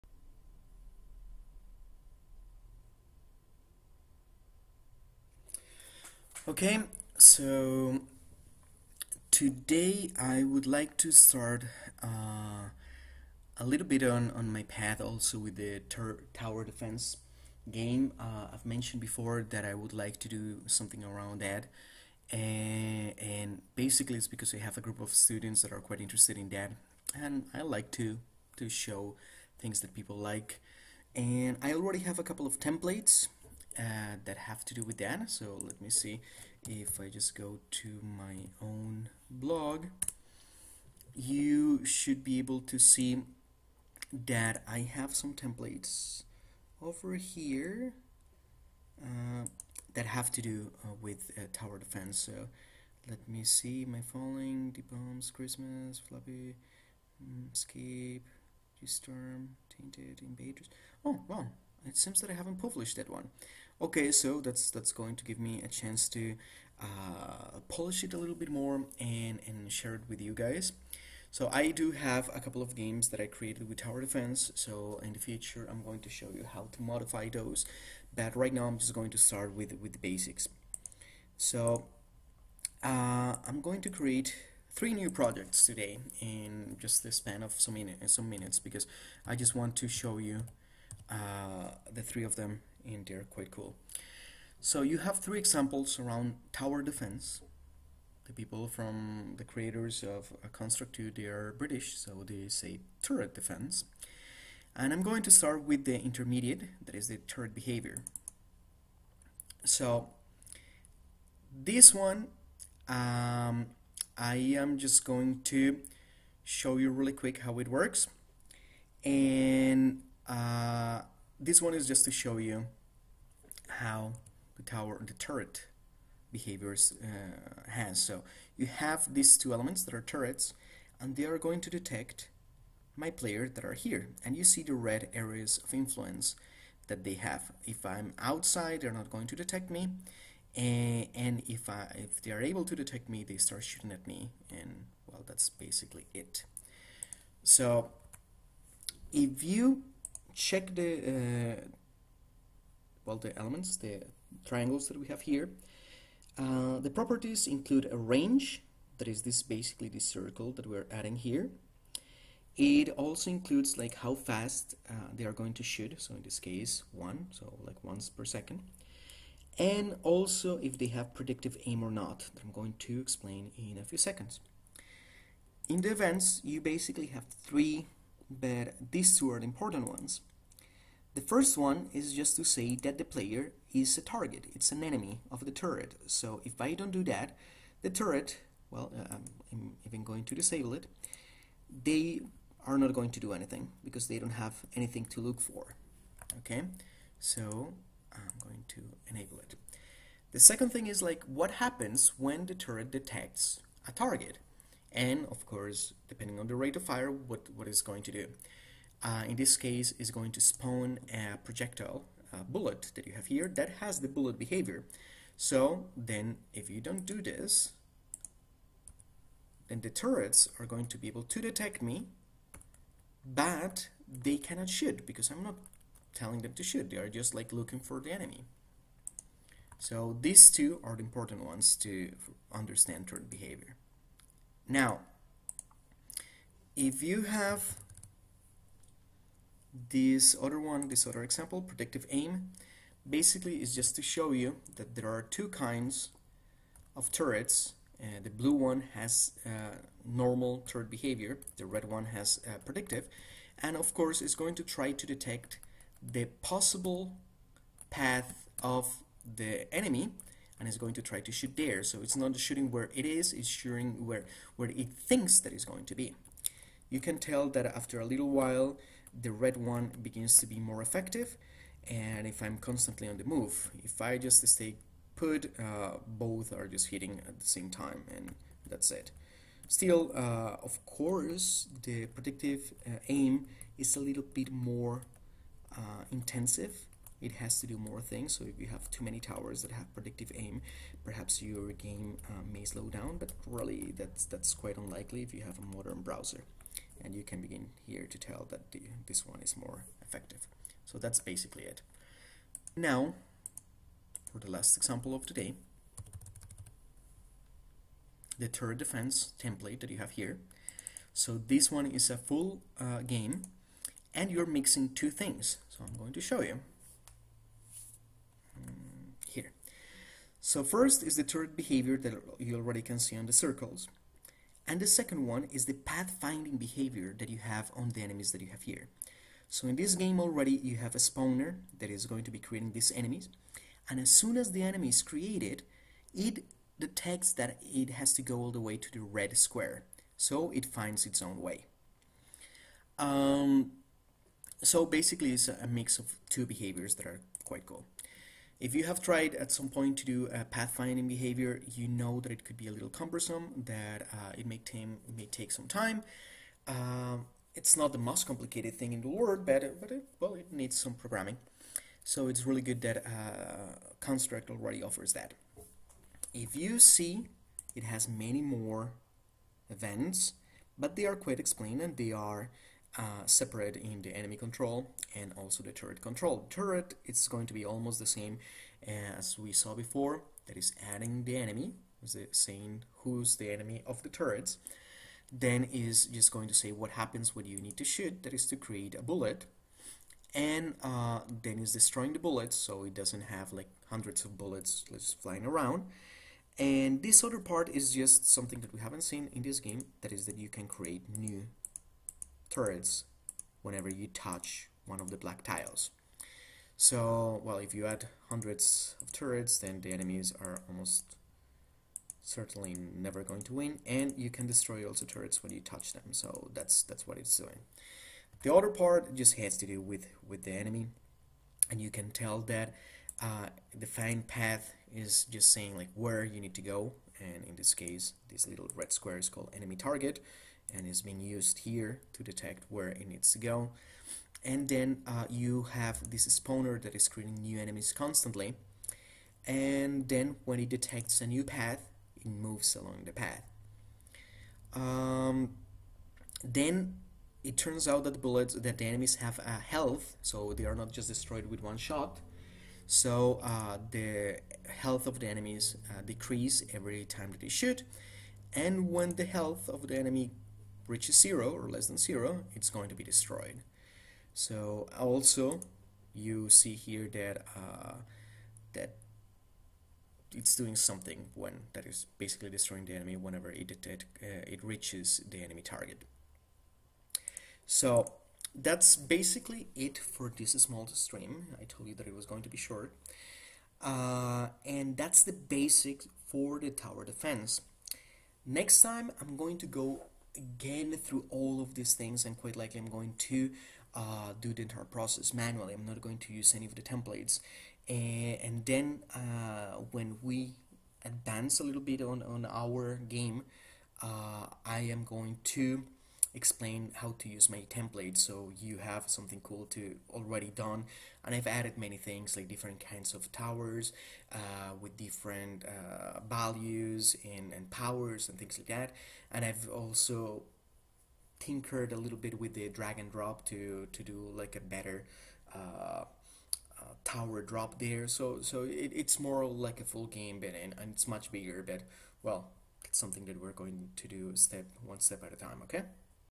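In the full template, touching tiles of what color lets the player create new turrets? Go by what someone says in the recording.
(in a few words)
Black.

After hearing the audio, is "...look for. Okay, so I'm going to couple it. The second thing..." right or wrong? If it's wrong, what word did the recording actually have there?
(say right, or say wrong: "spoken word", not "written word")
wrong: "enable", not "couple".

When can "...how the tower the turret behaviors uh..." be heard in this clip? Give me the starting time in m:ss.
2:03.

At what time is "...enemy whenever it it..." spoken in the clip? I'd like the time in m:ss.
7:52.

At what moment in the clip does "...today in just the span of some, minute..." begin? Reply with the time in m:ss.
1:25.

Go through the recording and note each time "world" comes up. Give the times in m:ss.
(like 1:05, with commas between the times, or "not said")
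5:59.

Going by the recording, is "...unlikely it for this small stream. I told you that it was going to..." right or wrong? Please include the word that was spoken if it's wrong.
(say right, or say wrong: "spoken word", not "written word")
wrong: "basically", not "unlikely".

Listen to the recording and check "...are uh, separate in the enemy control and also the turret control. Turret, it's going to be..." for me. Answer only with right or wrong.
right.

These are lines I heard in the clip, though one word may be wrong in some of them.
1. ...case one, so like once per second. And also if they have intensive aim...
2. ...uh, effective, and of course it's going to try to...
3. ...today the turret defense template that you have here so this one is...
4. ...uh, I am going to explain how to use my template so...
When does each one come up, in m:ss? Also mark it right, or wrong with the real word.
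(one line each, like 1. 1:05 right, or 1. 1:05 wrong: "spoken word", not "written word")
1. 2:46 wrong: "predictive", not "intensive"
2. 4:12 wrong: "predictive", not "effective"
3. 5:05 right
4. 8:24 right.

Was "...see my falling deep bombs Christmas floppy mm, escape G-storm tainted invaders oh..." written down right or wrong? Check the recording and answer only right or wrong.
right.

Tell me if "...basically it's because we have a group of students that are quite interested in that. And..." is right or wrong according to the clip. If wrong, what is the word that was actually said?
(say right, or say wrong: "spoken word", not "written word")
right.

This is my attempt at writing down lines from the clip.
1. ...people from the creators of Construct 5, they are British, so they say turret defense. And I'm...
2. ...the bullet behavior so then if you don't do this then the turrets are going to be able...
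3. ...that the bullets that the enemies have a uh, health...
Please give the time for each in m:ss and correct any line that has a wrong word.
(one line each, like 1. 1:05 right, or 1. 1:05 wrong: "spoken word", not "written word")
1. 1:38 wrong: "2", not "5"
2. 3:33 right
3. 7:28 right.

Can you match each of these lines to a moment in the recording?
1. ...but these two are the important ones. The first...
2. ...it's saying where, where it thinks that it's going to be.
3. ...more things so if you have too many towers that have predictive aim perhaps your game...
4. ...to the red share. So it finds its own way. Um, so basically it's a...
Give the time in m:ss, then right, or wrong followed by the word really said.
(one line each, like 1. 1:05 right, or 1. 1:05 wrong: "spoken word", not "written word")
1. 2:58 right
2. 4:23 wrong: "shooting", not "saying"
3. 4:47 right
4. 5:38 wrong: "square", not "share".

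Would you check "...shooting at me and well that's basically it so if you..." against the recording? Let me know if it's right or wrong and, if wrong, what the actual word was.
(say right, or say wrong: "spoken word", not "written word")
right.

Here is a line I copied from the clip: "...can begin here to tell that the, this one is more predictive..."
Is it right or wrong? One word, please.
wrong.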